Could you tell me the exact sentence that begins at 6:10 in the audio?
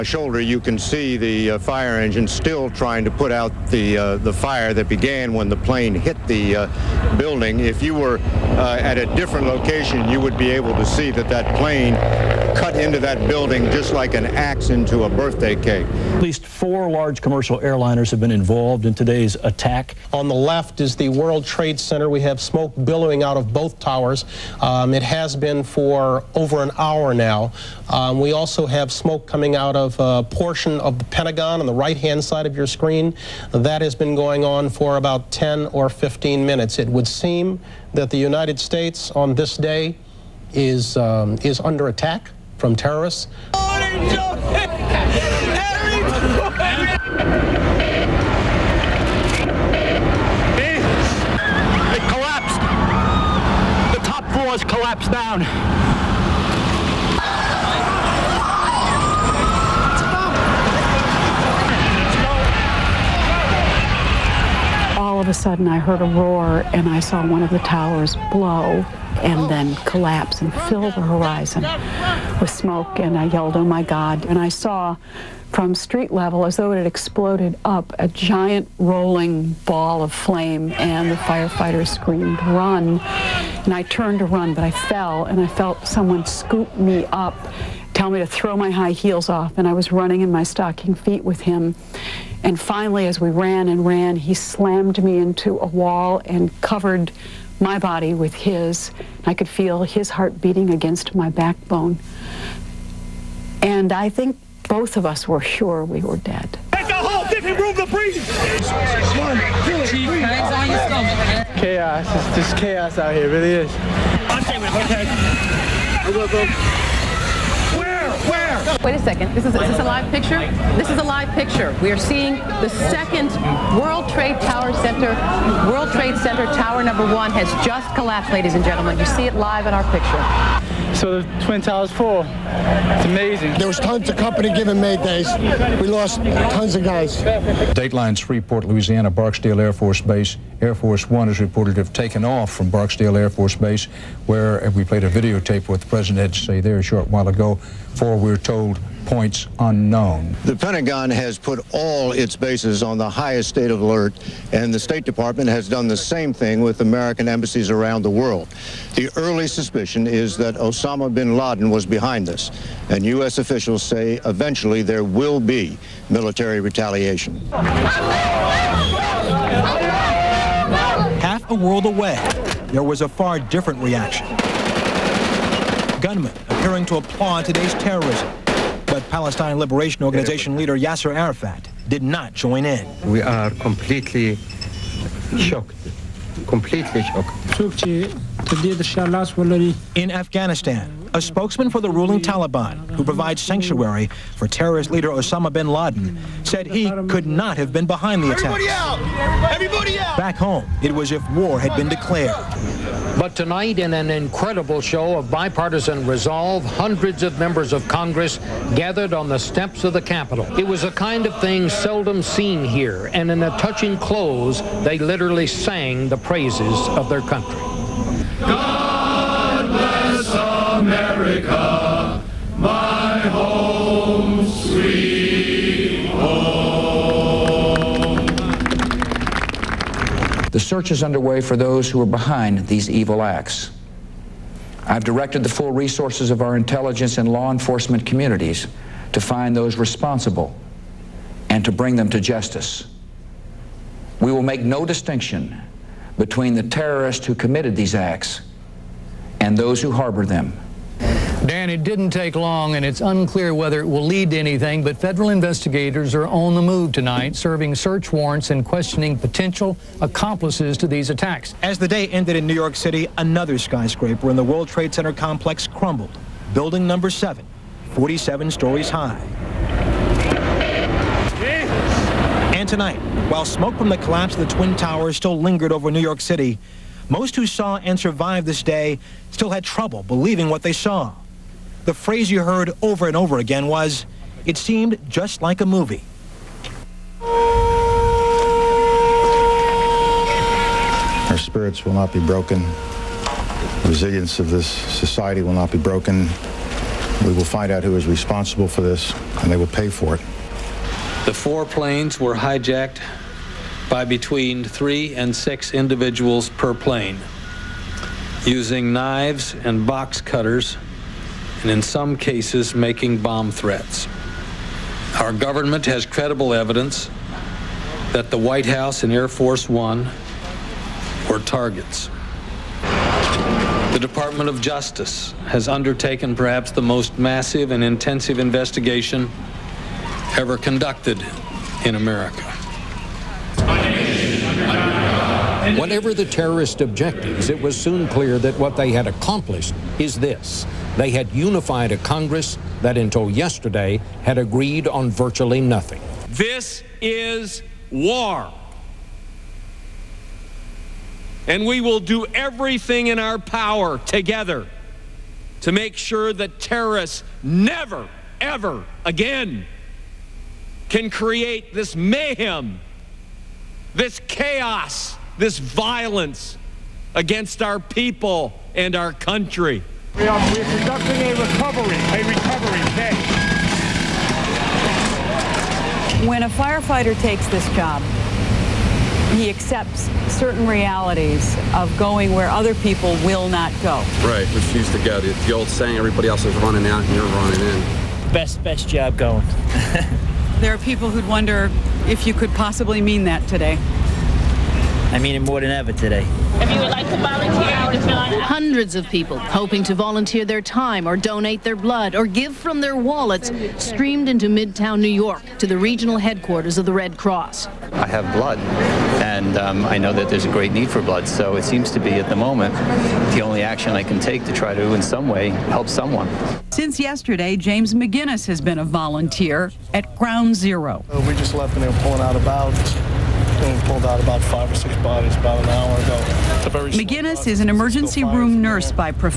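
We are, we are conducting a recovery, a recovery day.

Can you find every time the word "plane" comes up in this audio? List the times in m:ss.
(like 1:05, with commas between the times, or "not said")
0:05, 0:11, 5:01, 5:06.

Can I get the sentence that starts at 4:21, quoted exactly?
As the day ended in New York City, another skyscraper in the World Trade Center complex crumbled.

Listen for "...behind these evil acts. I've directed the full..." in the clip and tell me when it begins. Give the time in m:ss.
3:52.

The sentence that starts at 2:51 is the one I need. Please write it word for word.
Half a world away, there was a far different reaction gunmen appearing to applaud today's terrorism.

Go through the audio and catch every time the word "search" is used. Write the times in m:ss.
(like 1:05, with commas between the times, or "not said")
3:50, 4:17.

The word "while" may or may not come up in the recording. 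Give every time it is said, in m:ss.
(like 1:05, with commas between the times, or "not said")
2:27, 4:33.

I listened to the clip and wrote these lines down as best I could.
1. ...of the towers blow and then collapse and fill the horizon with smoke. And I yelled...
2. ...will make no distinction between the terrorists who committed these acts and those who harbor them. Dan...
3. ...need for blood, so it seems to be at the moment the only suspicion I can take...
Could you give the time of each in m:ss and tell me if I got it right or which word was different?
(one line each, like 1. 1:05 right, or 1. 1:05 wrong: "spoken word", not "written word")
1. 1:07 right
2. 4:04 right
3. 6:50 wrong: "action", not "suspicion".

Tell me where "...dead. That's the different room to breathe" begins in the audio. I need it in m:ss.
1:46.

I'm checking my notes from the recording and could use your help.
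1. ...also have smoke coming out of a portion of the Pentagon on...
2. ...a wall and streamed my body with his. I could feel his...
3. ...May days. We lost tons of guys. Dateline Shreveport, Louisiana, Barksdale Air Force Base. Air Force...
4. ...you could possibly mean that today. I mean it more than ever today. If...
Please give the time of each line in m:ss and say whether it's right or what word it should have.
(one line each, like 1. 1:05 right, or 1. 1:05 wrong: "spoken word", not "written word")
1. 0:28 right
2. 1:35 wrong: "covered", not "streamed"
3. 2:14 right
4. 6:32 right.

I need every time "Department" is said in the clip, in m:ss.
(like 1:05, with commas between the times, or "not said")
2:35, 5:23.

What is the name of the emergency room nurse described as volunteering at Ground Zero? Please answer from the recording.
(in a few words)
James McGinnis.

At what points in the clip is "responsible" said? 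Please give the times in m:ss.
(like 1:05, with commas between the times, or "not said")
3:59, 4:58.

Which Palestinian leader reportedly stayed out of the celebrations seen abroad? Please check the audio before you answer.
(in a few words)
Yasser Arafat.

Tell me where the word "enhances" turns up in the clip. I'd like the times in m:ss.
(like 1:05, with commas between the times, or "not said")
not said.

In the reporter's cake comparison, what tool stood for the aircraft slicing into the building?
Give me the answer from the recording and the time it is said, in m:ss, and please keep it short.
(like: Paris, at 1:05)
an axe, at 0:14.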